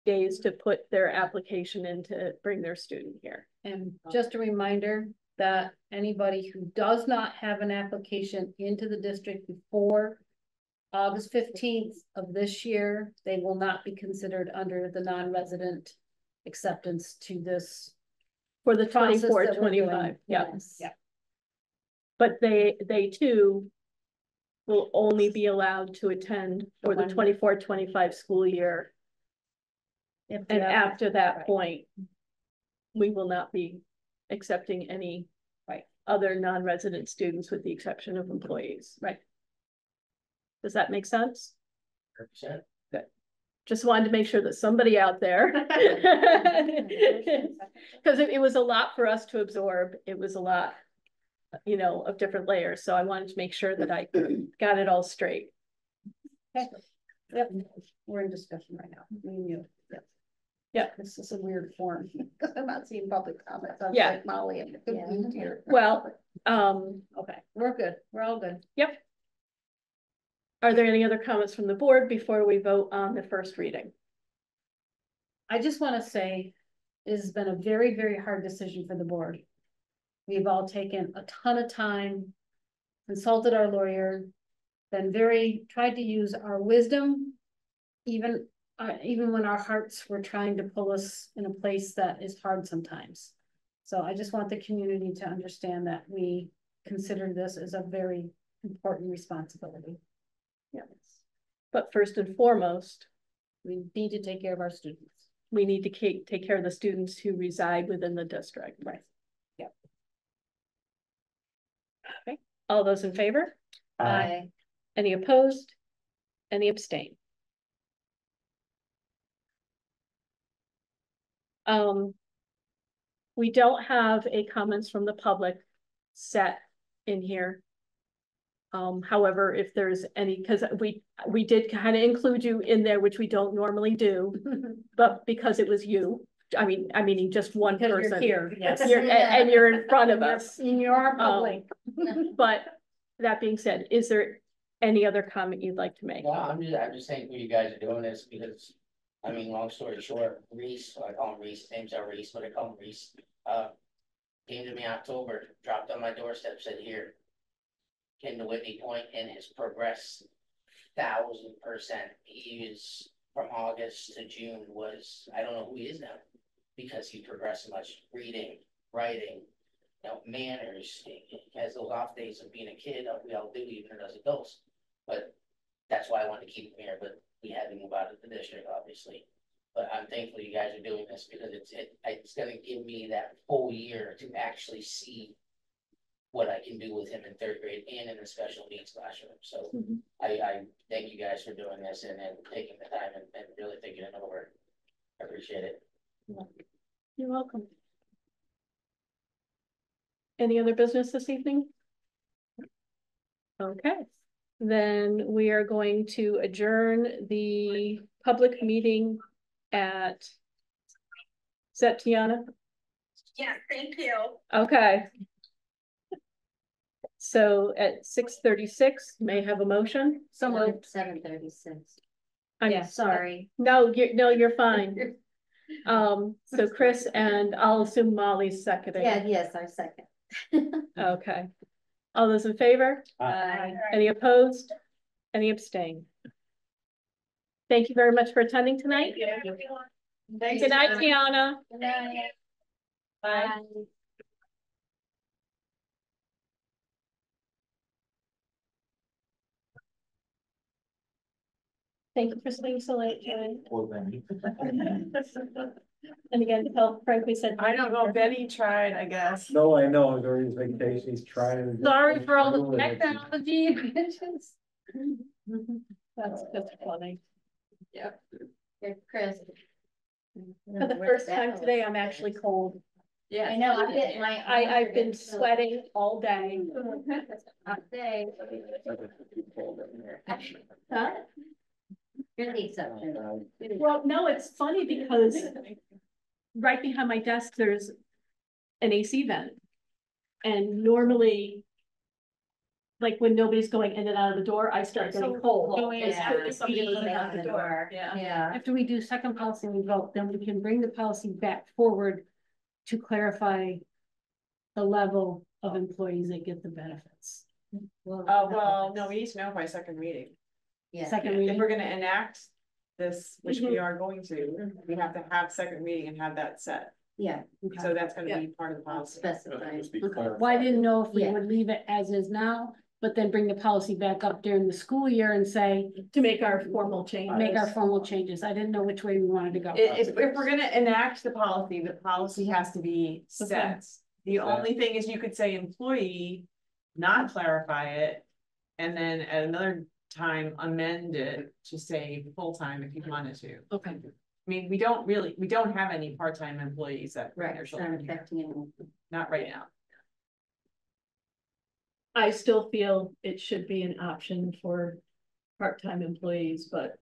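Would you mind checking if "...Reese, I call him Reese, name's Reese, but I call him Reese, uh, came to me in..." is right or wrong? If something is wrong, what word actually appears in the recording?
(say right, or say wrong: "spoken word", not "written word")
right.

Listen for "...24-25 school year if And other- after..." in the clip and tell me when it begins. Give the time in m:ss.
0:27.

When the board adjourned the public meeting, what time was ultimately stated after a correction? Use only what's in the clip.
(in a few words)
7:36.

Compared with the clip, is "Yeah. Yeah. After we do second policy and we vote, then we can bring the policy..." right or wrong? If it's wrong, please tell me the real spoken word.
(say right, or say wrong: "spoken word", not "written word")
right.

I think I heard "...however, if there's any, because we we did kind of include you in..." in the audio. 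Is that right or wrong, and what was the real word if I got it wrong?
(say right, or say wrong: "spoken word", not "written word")
right.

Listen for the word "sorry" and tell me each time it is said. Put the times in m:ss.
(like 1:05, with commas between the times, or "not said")
3:42, 4:21.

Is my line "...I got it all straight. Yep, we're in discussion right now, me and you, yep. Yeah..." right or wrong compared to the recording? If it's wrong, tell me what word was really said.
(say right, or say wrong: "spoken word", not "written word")
right.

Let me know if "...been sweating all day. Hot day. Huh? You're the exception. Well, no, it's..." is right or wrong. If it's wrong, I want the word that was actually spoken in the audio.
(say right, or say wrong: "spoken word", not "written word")
right.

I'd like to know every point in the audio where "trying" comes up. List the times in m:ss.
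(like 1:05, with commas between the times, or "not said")
1:30, 4:21.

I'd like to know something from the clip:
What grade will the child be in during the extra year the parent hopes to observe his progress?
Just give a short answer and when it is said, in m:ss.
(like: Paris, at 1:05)
third grade, at 3:07.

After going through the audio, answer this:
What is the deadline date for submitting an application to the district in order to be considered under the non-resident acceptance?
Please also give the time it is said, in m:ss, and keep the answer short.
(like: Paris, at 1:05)
August 15, at 0:10.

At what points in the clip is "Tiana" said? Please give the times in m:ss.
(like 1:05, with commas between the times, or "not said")
3:32, 4:00.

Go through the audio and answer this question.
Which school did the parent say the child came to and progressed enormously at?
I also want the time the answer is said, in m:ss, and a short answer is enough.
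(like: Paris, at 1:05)
Whitney Point, at 2:38.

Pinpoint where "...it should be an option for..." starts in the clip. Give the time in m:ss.
5:53.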